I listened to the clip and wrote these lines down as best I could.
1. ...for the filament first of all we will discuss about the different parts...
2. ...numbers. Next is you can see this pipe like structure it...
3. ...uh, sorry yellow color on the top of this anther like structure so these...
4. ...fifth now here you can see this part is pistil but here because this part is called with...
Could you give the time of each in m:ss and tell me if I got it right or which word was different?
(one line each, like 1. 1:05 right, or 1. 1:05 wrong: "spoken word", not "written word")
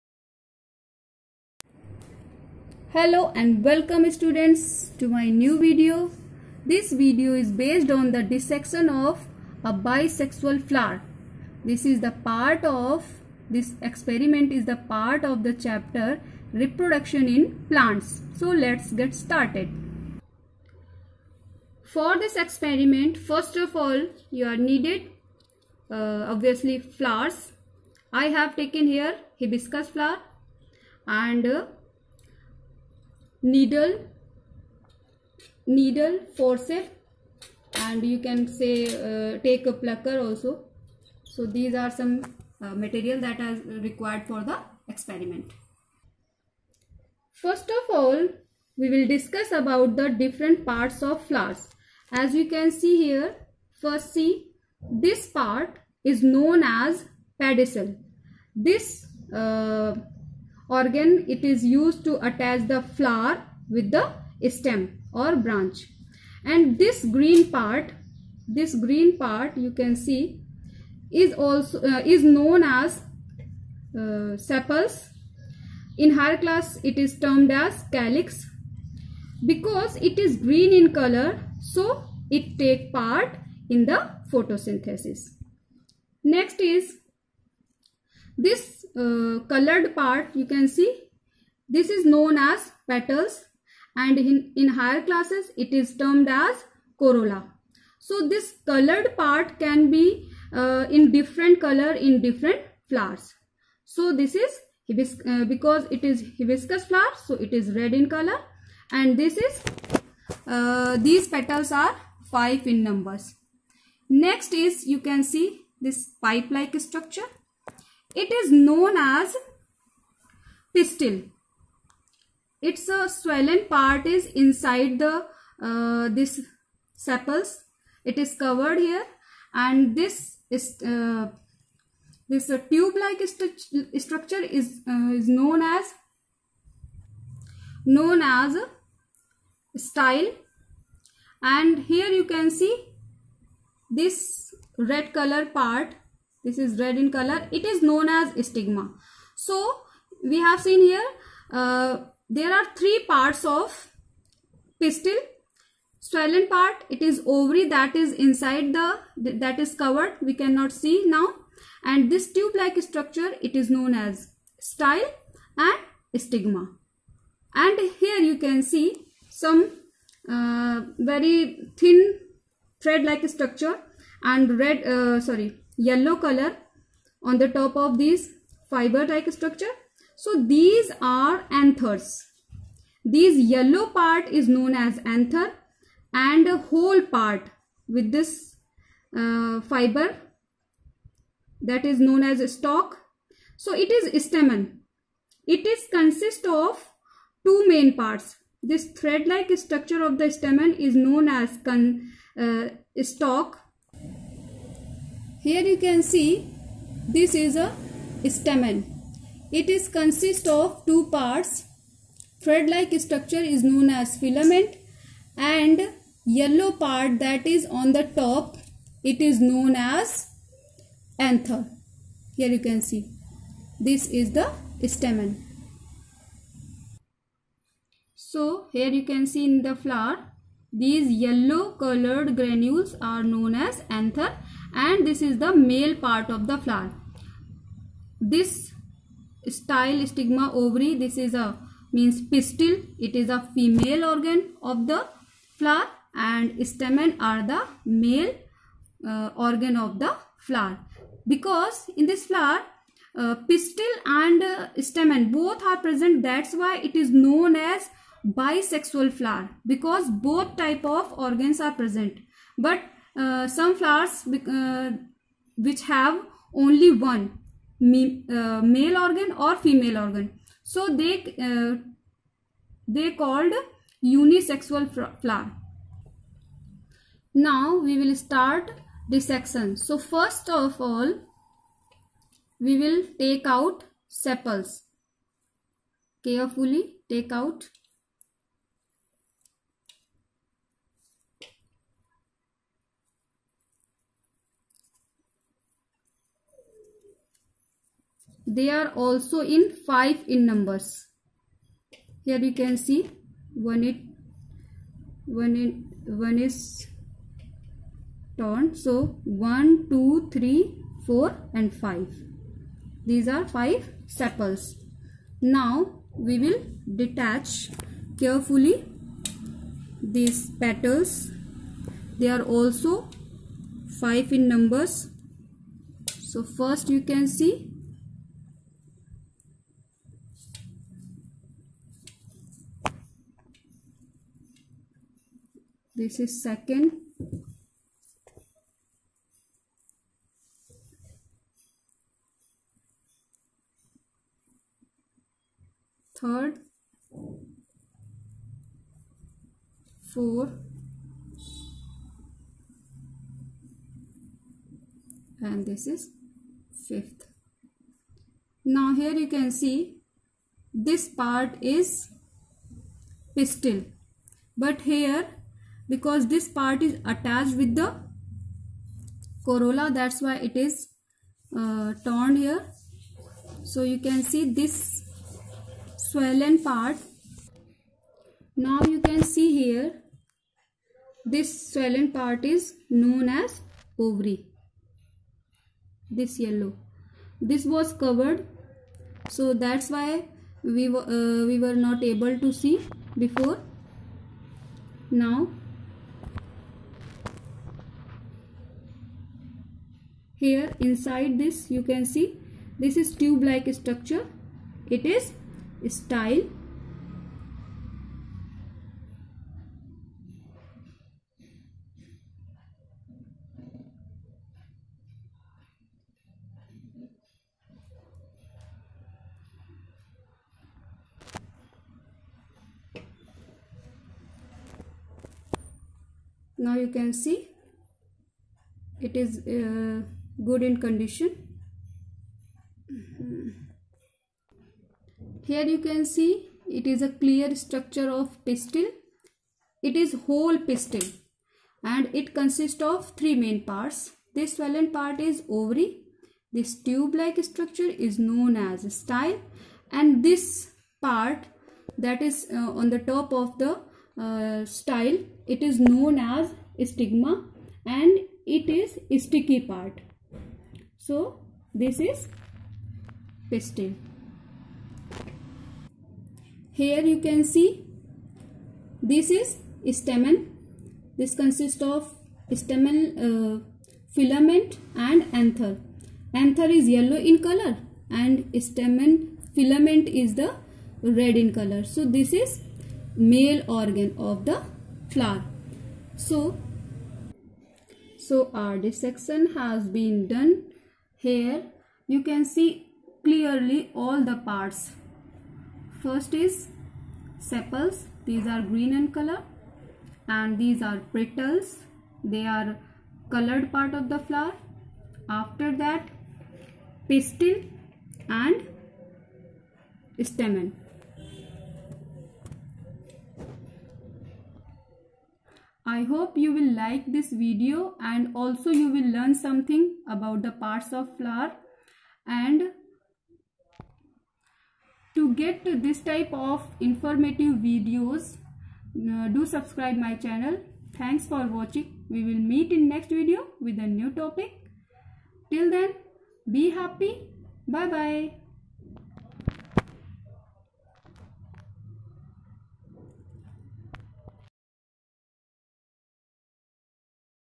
1. 0:44 wrong: "experiment", not "filament"
2. 1:52 right
3. 2:54 wrong: "fiber", not "anther"
4. 5:56 wrong: "attached", not "called".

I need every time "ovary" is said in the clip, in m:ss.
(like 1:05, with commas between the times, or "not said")
2:37, 4:00, 6:24, 7:25.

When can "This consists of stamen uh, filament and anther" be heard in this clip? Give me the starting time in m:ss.
7:51.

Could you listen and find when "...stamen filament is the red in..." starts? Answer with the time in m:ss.
7:58.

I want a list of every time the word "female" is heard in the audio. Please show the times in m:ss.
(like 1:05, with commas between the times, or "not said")
4:03, 4:29.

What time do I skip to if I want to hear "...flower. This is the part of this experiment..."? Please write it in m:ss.
0:10.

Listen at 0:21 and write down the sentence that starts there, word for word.
For this experiment first of all you are needed uh, obviously flowers.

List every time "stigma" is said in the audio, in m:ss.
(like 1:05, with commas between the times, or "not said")
2:28, 2:46, 4:00, 7:36.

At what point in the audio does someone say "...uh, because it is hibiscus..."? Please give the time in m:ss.
1:44.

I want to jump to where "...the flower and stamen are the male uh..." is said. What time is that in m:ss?
4:04.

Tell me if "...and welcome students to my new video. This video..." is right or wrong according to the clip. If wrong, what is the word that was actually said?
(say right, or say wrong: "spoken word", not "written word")
right.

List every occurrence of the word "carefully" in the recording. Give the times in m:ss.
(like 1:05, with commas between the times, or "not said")
4:46, 5:18.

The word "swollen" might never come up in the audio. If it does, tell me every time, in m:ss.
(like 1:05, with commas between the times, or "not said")
2:03, 2:35, 6:16, 6:21, 7:24.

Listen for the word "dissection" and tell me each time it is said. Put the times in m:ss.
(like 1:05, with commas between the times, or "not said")
0:08, 4:39, 8:08.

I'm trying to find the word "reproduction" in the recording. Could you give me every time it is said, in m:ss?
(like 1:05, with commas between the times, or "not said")
0:16.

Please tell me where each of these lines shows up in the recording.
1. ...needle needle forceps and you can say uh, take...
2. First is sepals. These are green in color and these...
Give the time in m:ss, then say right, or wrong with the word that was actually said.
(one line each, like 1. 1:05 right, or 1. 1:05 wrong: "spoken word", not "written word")
1. 0:33 right
2. 8:16 right.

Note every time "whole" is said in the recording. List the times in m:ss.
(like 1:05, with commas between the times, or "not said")
3:06, 7:20.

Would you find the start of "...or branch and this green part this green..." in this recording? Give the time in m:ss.
1:05.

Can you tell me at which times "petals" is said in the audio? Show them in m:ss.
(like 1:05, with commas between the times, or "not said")
1:32, 1:51, 5:20, 8:21.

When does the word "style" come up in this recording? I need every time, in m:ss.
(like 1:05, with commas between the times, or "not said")
2:19, 2:44, 3:59, 6:45, 7:28, 7:34.